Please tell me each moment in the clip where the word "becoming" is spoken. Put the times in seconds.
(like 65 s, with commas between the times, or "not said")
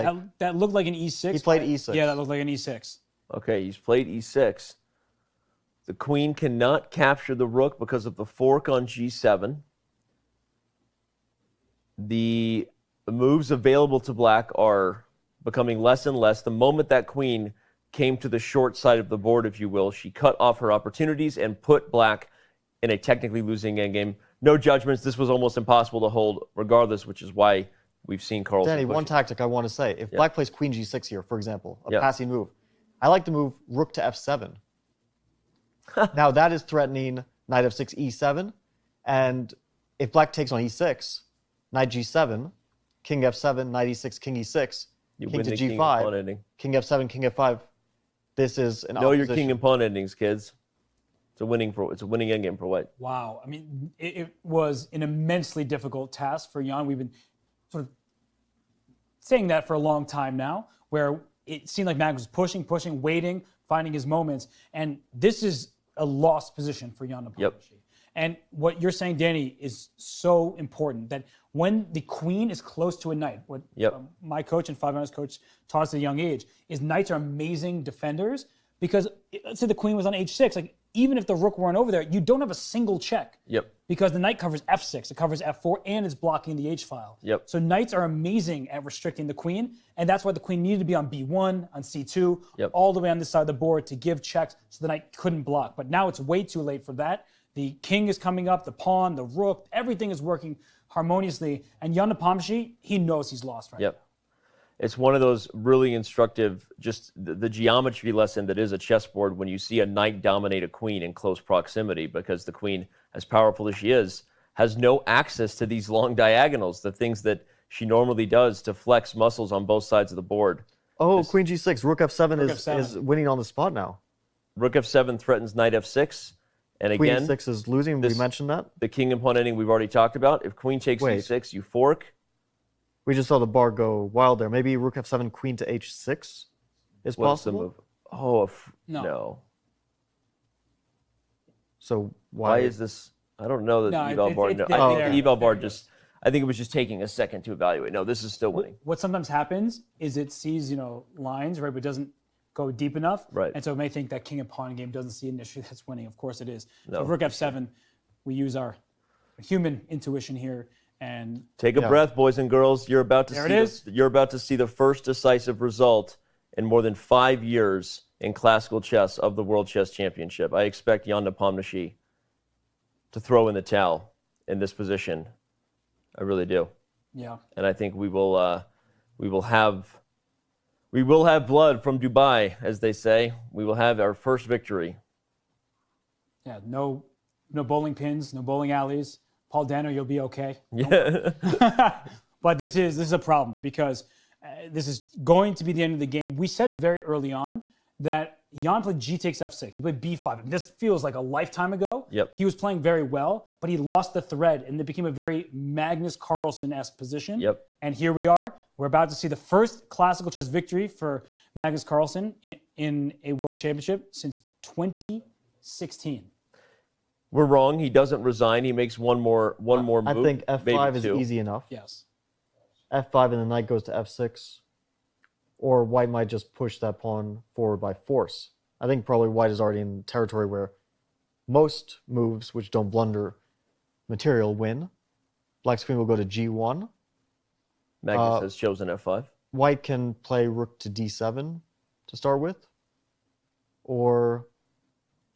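15 s.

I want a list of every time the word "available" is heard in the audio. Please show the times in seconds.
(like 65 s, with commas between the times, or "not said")
13 s.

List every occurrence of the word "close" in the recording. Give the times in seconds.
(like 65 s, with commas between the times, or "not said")
72 s, 111 s.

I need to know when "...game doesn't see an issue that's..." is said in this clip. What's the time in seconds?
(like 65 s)
154 s.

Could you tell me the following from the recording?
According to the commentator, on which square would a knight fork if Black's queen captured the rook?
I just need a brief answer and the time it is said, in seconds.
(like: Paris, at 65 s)
G7, at 8 s.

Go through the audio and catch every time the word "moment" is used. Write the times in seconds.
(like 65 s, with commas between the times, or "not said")
16 s, 64 s.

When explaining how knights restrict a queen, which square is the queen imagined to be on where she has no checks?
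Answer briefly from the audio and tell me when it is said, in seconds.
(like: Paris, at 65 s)
h6, at 79 s.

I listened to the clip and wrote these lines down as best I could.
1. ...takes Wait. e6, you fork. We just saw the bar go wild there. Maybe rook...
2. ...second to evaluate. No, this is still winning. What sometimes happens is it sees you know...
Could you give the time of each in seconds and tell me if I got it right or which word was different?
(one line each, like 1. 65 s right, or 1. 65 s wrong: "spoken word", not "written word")
1. 130 s right
2. 147 s right.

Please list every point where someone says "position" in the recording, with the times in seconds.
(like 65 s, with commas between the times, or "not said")
66 s, 174 s, 206 s.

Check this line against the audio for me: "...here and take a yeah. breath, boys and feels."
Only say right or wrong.
wrong.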